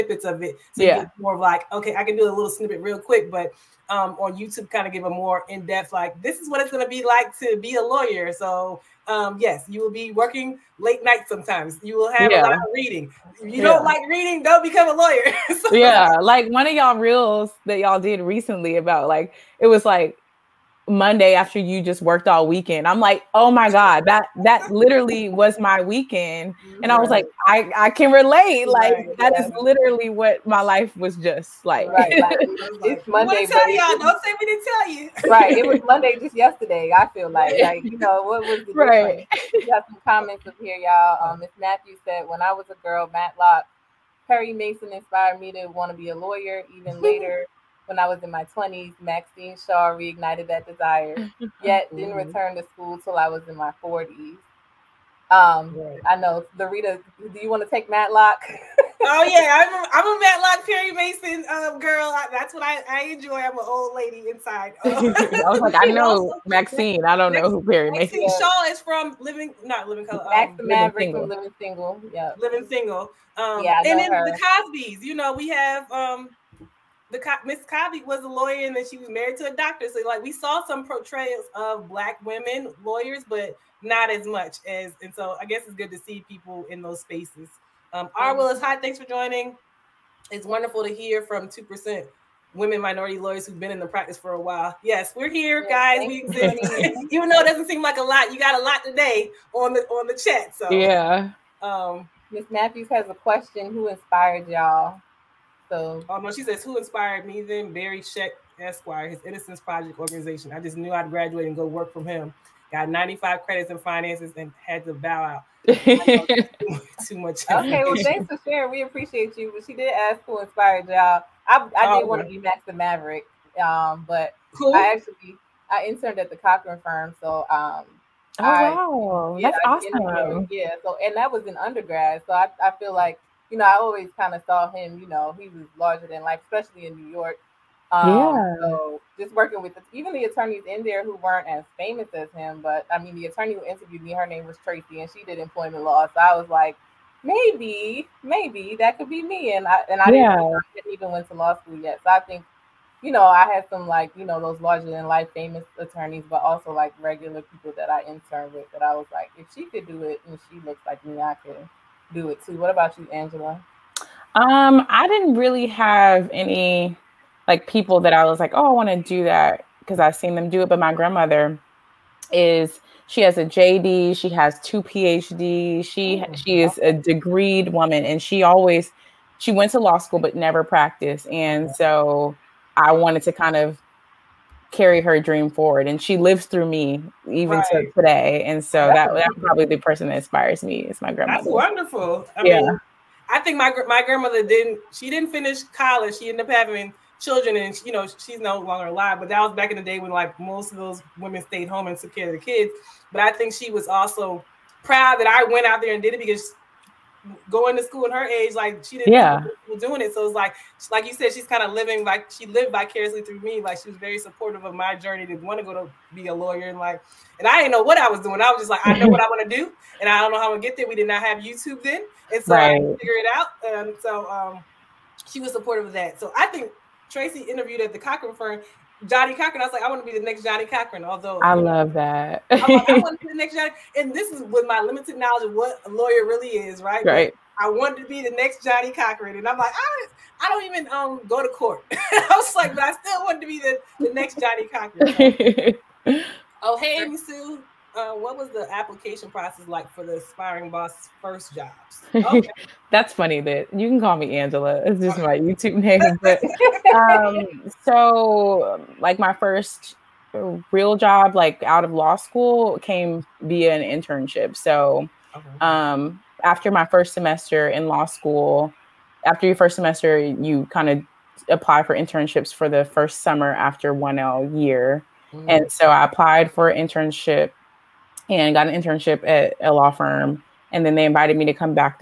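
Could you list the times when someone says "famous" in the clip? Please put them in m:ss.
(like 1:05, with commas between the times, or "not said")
2:21, 2:35.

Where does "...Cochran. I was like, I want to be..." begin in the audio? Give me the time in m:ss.
3:49.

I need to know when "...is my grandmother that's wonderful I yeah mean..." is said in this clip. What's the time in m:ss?
3:10.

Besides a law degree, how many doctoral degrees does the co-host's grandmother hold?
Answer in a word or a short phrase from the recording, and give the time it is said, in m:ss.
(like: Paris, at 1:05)
2, at 2:54.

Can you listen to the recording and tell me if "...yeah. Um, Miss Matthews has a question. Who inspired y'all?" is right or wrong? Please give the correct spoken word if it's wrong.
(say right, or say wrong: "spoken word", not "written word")
right.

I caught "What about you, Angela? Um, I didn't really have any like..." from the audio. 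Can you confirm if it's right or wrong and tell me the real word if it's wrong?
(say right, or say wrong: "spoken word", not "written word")
right.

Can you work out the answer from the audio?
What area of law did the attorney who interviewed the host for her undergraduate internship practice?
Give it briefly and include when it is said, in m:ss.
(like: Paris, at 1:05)
employment law, at 2:25.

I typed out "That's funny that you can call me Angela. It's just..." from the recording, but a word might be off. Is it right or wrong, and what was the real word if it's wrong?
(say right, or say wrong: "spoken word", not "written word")
right.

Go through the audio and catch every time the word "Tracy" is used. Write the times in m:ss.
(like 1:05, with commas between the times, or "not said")
2:24, 3:47.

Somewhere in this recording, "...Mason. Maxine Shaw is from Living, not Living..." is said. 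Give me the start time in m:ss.
1:07.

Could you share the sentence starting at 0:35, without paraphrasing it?
It was Monday just yesterday, I feel like.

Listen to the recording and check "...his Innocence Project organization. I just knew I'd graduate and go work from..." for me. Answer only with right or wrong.
right.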